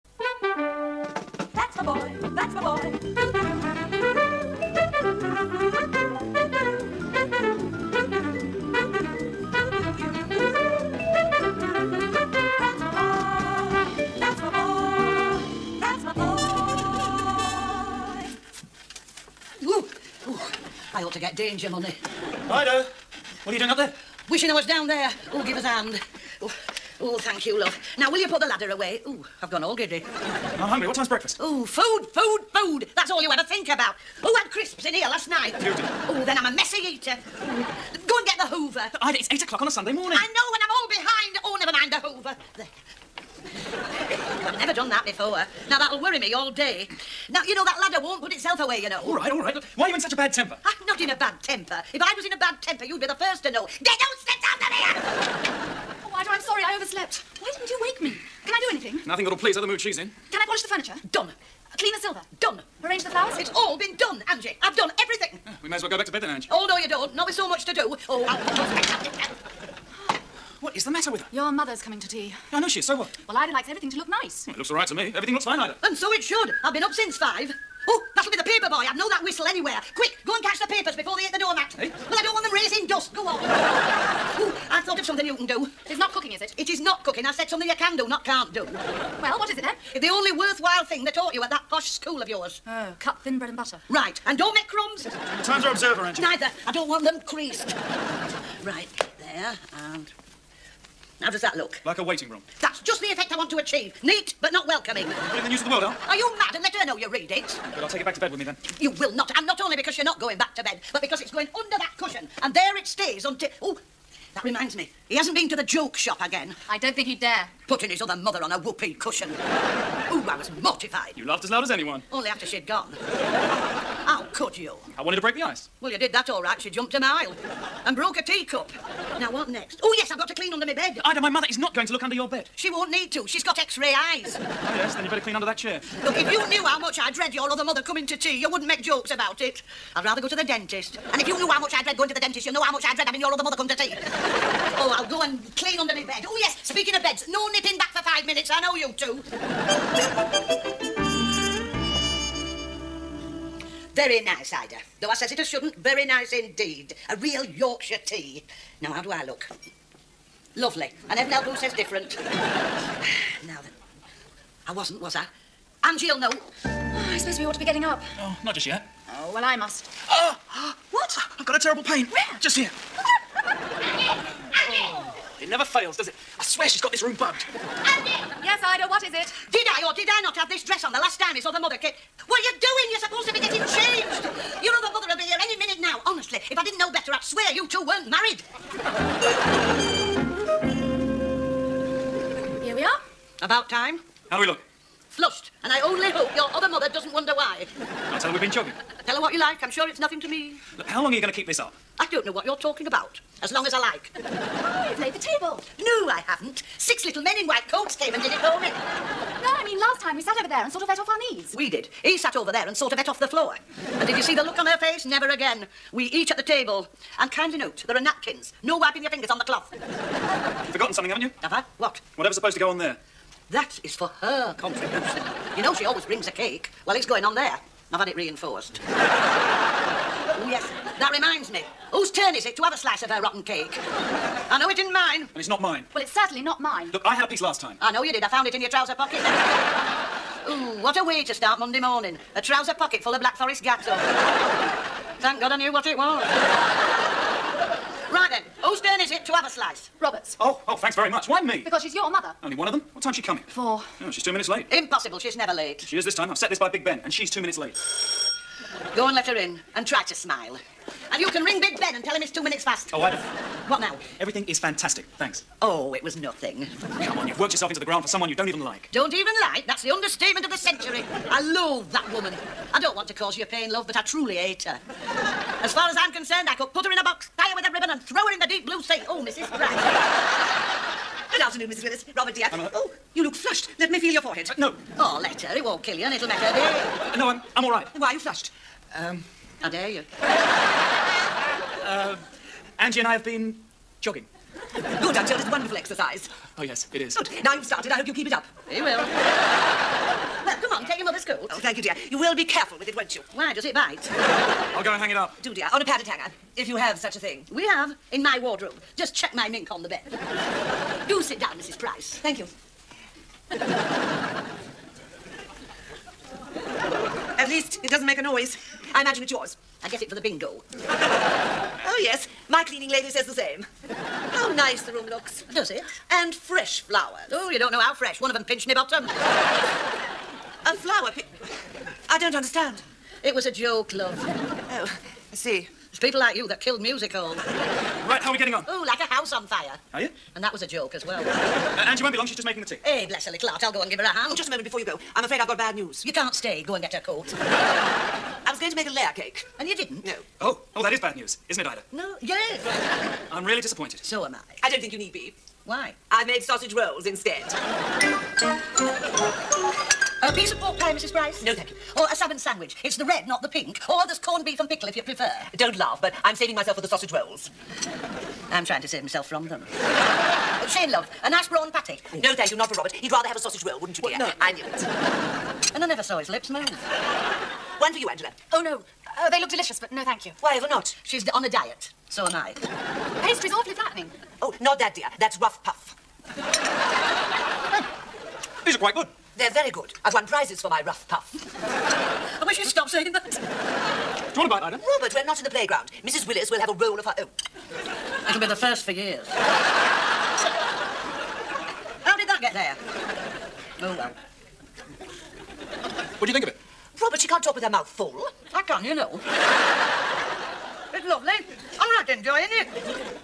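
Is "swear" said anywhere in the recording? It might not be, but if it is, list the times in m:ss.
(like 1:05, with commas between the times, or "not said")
2:56, 3:07.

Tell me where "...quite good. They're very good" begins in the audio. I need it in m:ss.
6:28.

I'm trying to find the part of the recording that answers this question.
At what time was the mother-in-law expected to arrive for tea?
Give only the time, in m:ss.
4:13.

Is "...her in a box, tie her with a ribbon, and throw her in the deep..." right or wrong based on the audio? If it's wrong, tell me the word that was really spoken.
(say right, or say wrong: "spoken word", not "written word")
right.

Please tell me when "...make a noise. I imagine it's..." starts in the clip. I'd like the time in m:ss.
5:18.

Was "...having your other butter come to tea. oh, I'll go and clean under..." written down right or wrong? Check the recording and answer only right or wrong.
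wrong.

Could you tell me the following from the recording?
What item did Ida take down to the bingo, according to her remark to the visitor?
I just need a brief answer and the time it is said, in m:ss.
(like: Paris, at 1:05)
mink, at 5:09.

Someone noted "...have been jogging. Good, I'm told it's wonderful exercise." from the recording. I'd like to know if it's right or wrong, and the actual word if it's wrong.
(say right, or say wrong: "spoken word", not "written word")
right.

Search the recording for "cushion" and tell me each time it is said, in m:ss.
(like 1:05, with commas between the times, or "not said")
1:51, 1:58.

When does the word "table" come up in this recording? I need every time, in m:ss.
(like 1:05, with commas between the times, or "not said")
3:25, 3:36.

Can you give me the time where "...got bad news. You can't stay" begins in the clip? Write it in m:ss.
5:45.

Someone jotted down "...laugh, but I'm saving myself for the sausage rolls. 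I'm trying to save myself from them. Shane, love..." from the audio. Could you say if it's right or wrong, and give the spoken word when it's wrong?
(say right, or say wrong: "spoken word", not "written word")
right.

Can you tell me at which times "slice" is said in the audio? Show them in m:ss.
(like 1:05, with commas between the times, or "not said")
3:52, 4:09.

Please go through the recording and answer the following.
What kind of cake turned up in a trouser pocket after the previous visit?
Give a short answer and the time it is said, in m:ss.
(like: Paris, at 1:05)
Black Forest gateau, at 4:03.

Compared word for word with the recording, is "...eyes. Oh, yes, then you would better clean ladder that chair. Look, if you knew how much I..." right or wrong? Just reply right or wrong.
wrong.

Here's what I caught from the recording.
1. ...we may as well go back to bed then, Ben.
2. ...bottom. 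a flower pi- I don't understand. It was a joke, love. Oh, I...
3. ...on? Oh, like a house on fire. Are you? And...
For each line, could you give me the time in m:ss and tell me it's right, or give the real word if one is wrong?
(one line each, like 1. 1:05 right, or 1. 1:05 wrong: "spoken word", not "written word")
1. 1:05 wrong: "Angie", not "Ben"
2. 5:28 right
3. 5:38 right.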